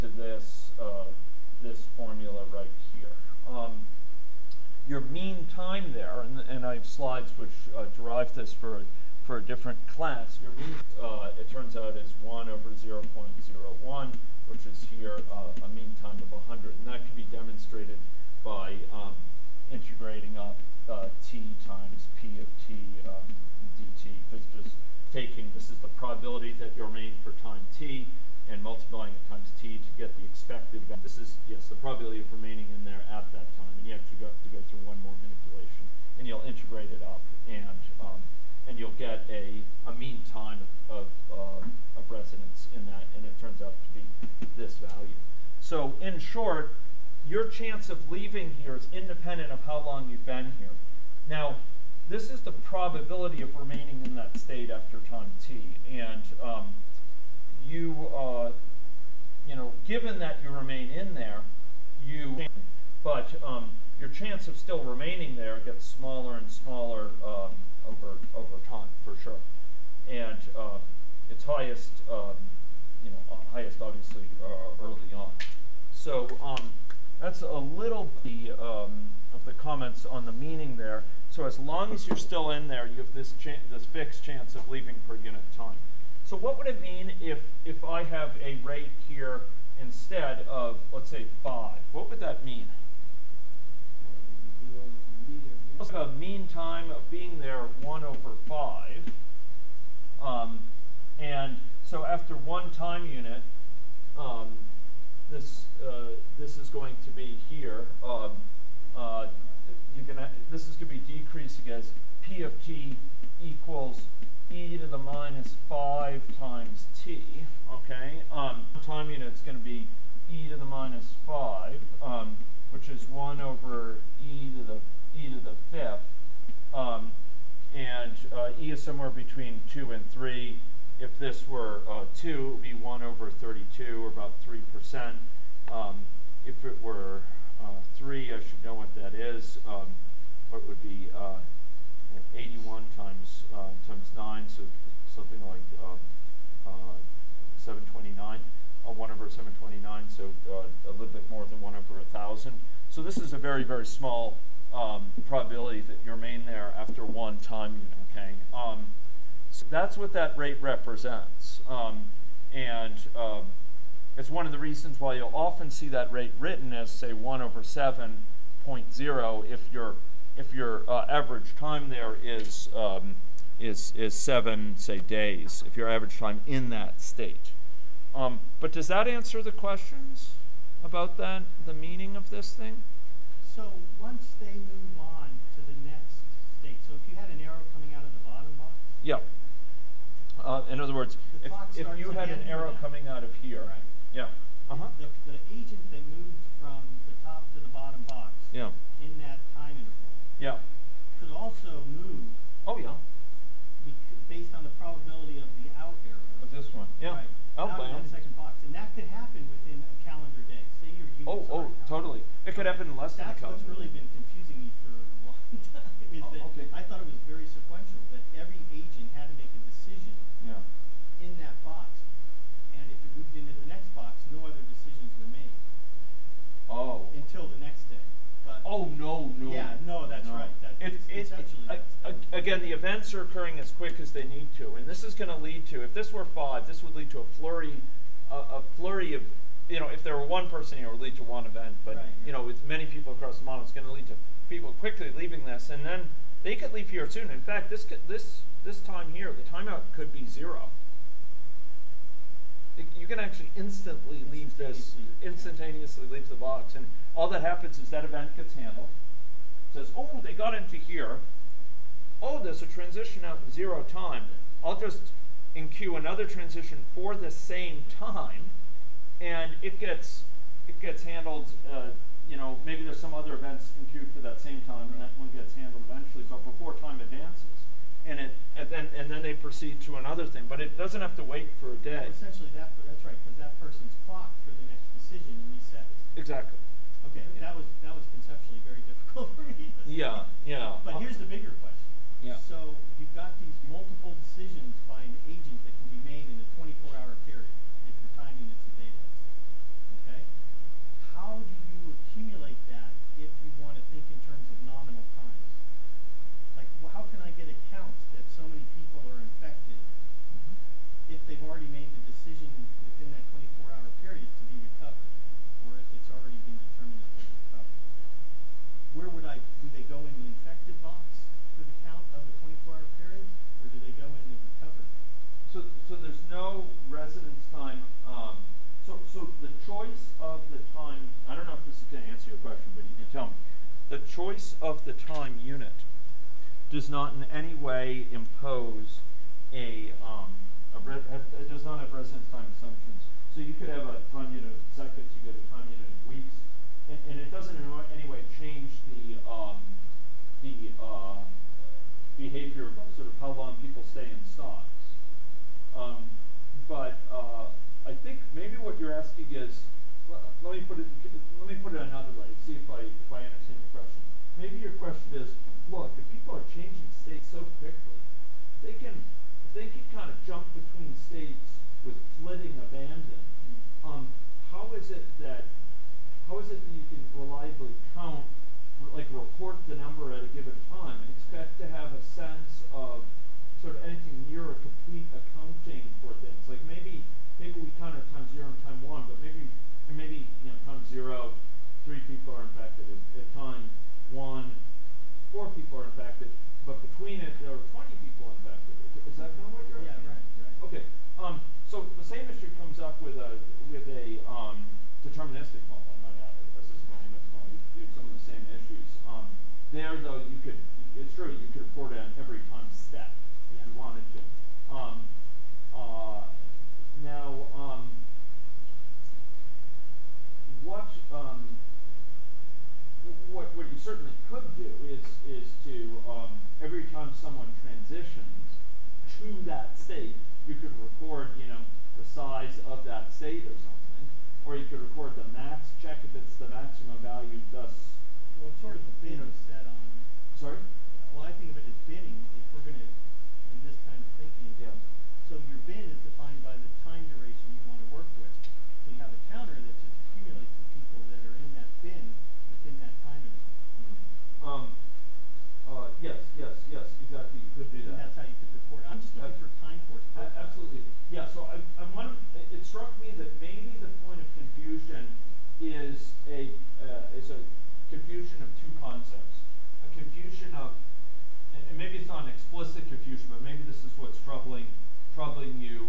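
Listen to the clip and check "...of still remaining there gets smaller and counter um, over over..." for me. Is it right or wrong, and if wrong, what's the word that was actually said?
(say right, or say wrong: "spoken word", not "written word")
wrong: "smaller", not "counter".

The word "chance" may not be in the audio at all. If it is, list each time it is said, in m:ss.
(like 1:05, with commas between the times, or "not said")
0:47, 1:04, 1:24.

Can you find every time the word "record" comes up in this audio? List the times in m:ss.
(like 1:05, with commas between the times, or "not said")
7:10, 7:14.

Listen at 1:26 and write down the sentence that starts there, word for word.
So what would it mean if, if I have a rate here instead of, let's say, 5?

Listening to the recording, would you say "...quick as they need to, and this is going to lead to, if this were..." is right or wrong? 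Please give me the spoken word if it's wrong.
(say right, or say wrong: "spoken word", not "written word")
right.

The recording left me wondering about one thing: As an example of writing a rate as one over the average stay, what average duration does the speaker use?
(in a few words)
7 days.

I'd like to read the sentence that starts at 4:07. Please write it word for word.
In fact, this could, this this time here, the timeout could be zero.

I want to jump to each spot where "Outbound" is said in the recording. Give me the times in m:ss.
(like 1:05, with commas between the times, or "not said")
3:27.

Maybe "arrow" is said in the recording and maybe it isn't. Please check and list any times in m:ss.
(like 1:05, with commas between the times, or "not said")
3:07, 3:12, 3:26.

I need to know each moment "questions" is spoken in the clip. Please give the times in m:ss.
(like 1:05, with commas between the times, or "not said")
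2:59, 4:51.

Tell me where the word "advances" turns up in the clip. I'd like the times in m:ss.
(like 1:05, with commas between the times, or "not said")
4:36.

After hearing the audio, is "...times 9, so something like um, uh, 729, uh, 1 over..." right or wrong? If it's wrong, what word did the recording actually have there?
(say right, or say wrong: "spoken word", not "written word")
right.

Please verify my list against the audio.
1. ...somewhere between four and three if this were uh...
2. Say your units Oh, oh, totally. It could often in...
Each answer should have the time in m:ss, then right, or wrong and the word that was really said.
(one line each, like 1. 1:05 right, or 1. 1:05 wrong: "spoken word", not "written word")
1. 2:08 wrong: "two", not "four"
2. 3:30 wrong: "happen", not "often".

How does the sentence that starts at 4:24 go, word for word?
I'll just enqueue another transition for the same time, and it gets it gets handled.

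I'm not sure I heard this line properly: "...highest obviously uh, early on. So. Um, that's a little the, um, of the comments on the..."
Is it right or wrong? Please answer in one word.
right.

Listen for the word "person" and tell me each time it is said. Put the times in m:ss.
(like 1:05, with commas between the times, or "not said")
4:00, 4:43.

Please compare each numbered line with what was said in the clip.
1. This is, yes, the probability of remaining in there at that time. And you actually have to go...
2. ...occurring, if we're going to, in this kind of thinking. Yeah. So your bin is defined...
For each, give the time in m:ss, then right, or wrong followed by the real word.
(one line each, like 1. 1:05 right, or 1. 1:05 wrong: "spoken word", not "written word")
1. 0:31 right
2. 7:21 wrong: "binning", not "occurring".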